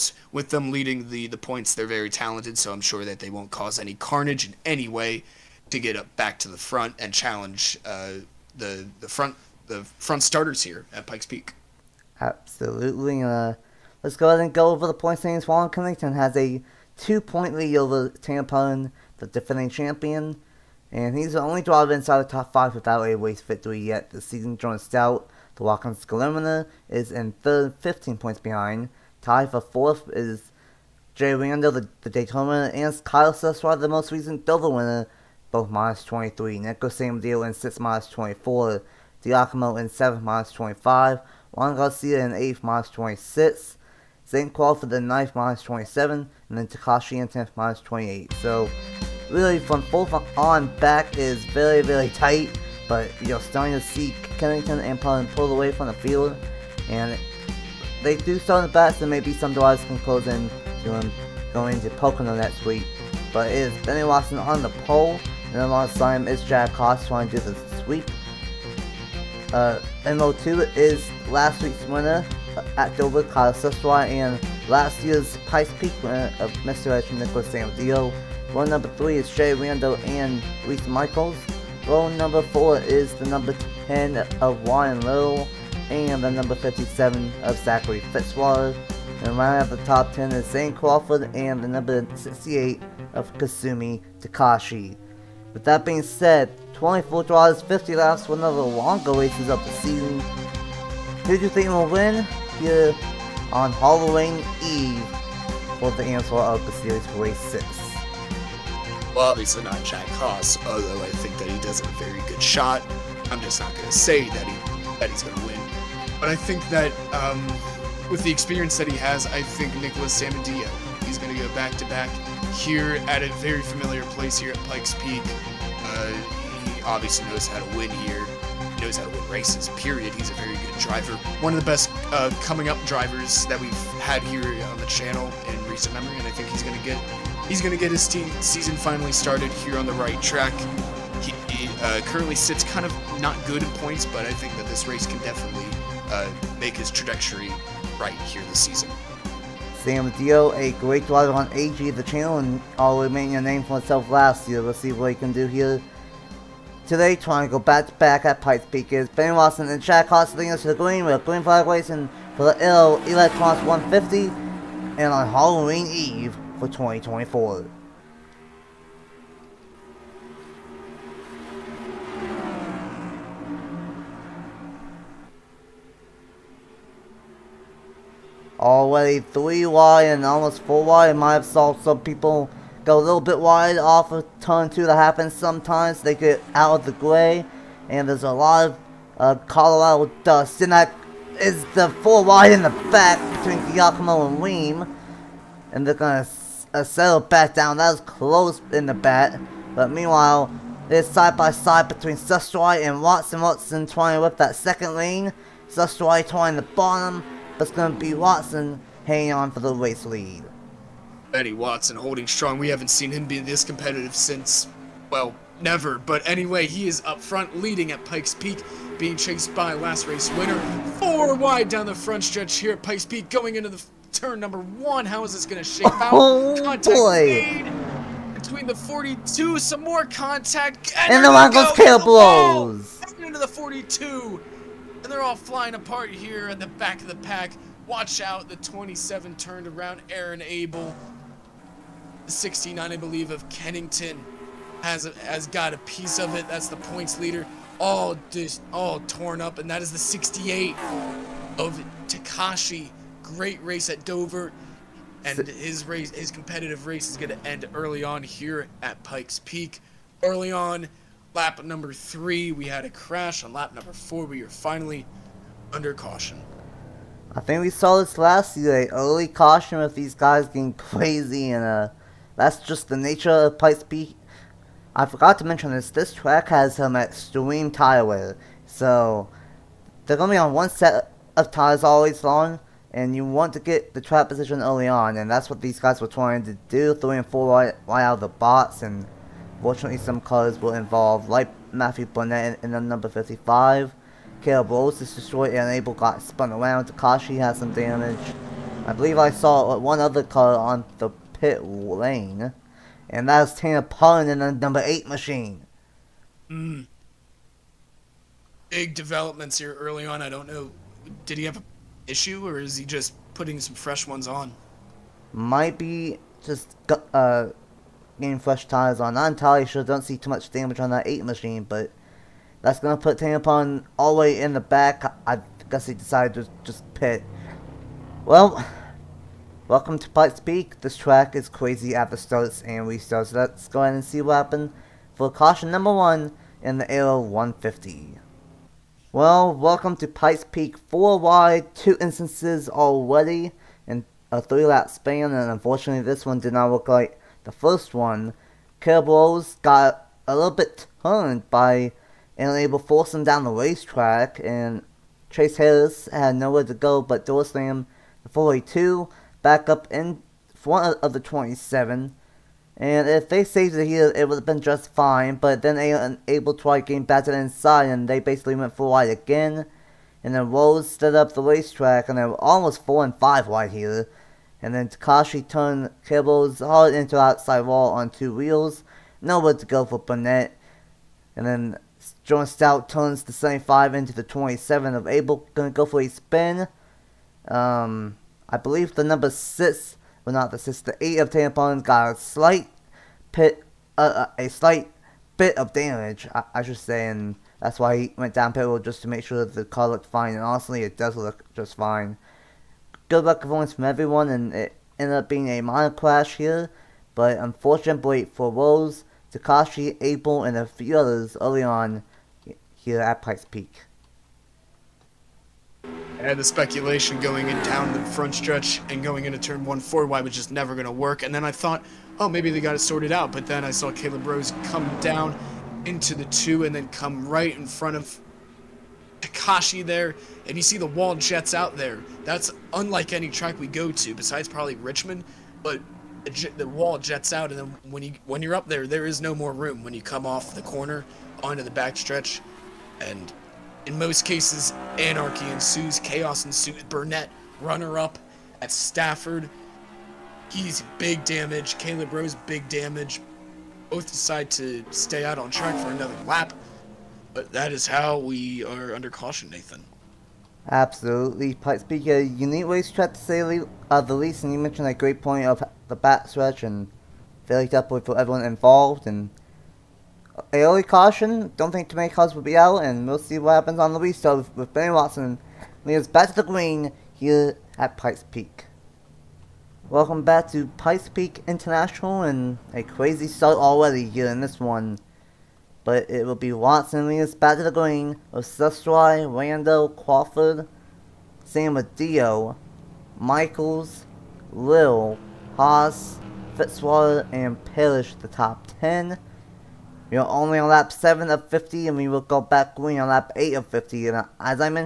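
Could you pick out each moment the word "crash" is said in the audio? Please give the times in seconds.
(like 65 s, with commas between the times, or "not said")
262 s, 405 s.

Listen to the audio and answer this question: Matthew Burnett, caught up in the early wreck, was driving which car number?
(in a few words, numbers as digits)
55.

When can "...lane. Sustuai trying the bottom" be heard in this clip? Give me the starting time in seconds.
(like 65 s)
204 s.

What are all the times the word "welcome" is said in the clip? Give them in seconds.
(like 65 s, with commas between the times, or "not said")
329 s, 339 s, 479 s.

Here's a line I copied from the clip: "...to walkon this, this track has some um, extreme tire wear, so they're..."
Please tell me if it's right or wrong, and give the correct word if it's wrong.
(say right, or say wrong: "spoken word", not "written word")
wrong: "mention", not "walkon".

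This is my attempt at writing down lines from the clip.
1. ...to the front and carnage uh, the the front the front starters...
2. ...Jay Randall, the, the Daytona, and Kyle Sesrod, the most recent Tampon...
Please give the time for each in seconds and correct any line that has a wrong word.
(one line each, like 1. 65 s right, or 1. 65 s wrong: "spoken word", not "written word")
1. 6 s wrong: "challenge", not "carnage"
2. 31 s wrong: "Dover", not "Tampon".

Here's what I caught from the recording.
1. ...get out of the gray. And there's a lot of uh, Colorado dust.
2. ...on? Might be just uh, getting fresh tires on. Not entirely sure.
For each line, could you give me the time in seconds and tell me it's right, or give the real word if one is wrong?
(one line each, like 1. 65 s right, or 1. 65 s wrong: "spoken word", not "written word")
1. 186 s right
2. 314 s right.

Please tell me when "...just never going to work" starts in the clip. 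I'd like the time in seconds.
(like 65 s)
420 s.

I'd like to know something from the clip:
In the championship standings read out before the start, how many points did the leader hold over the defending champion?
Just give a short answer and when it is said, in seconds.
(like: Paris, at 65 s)
2, at 16 s.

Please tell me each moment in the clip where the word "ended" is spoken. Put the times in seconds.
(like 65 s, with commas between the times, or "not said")
404 s.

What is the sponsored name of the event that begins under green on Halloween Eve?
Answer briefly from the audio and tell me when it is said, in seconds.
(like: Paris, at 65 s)
Arrow Electronics 150, at 162 s.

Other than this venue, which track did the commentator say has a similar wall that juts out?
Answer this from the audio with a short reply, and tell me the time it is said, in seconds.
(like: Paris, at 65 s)
Richmond, at 434 s.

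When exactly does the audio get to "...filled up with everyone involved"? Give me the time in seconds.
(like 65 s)
467 s.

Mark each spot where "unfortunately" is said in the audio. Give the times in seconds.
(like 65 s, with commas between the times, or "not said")
345 s, 407 s.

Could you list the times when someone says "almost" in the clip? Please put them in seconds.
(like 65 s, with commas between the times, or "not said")
180 s, 372 s.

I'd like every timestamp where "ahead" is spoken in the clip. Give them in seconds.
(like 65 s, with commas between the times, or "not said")
14 s, 333 s.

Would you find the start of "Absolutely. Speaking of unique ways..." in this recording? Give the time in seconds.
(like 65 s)
460 s.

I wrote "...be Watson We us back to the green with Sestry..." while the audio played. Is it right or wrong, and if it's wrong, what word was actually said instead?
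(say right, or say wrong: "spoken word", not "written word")
right.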